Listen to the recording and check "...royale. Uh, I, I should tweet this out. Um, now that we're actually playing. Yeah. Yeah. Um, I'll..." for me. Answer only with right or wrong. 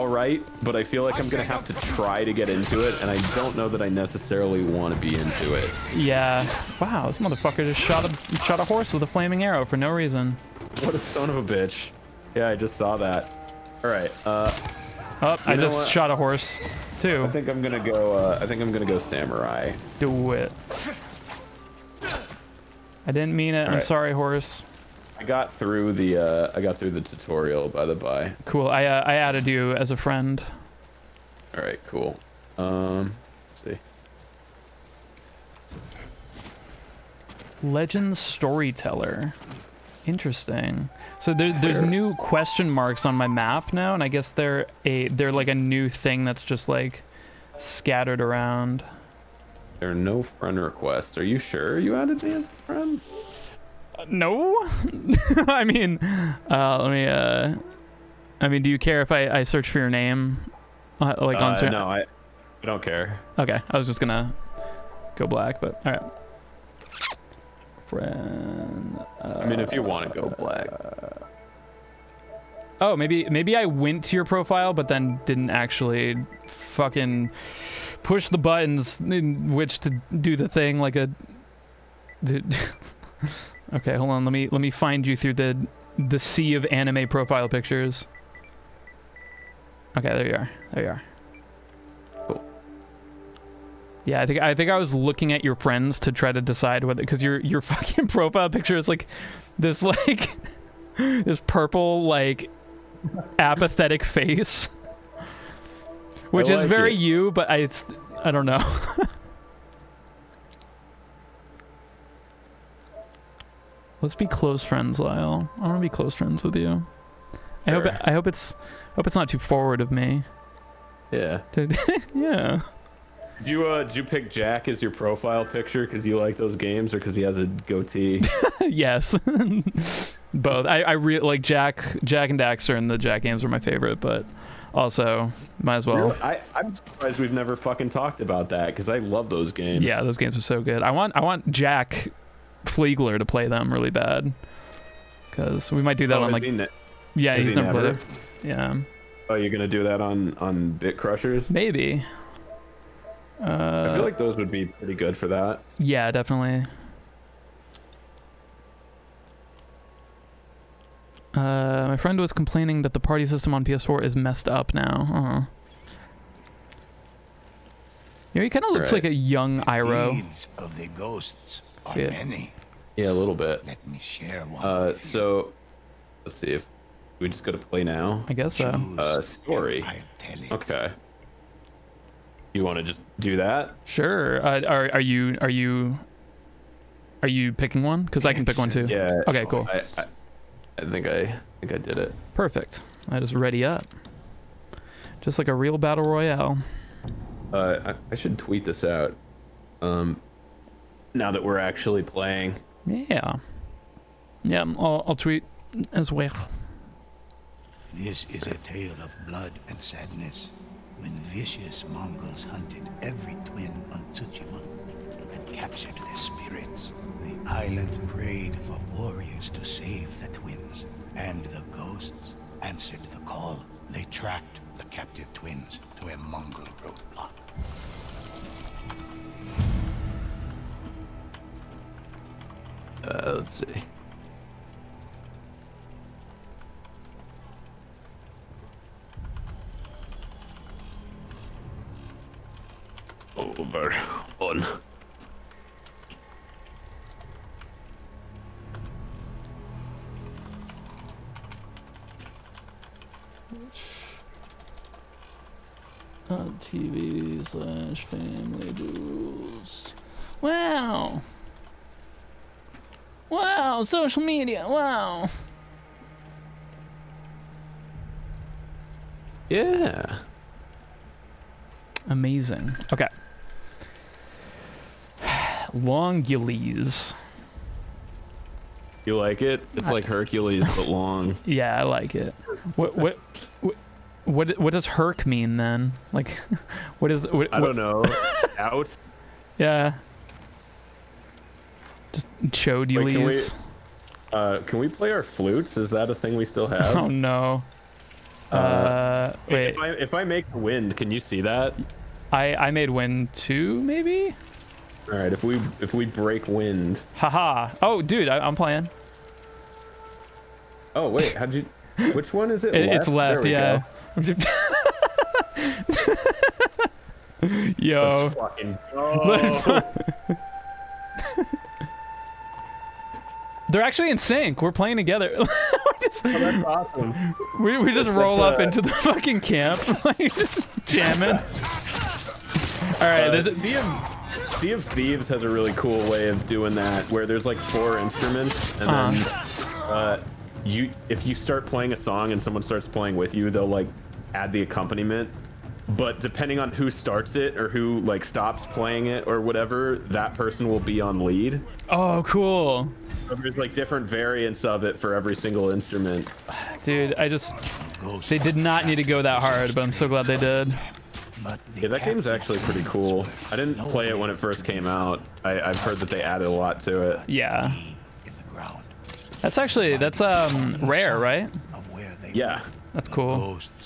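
right.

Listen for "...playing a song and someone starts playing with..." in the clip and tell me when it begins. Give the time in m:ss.
5:41.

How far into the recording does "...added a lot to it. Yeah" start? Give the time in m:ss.
6:06.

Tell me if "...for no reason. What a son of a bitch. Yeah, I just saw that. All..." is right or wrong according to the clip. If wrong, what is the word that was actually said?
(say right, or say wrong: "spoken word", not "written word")
right.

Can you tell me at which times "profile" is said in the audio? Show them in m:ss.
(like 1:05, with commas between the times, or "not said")
1:14, 1:27, 1:38, 2:04.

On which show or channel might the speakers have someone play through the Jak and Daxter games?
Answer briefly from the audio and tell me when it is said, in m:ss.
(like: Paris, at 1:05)
Bit Crushers, at 2:30.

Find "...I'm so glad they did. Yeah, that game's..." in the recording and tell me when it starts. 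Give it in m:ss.
5:59.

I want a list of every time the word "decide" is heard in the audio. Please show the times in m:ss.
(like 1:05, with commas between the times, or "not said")
1:36.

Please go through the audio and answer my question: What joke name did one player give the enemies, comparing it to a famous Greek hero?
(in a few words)
Longules.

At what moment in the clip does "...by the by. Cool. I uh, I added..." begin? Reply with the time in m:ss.
0:27.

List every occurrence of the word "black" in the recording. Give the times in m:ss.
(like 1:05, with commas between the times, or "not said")
1:05, 1:10.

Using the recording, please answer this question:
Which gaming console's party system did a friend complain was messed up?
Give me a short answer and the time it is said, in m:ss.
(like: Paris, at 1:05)
PS4, at 2:43.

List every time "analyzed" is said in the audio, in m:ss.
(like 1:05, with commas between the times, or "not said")
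not said.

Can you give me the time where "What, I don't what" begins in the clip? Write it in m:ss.
4:47.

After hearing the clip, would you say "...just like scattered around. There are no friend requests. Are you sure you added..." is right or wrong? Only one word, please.
right.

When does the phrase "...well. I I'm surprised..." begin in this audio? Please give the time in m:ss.
2:15.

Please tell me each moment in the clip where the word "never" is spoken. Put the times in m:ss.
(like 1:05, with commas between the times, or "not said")
2:17, 2:27.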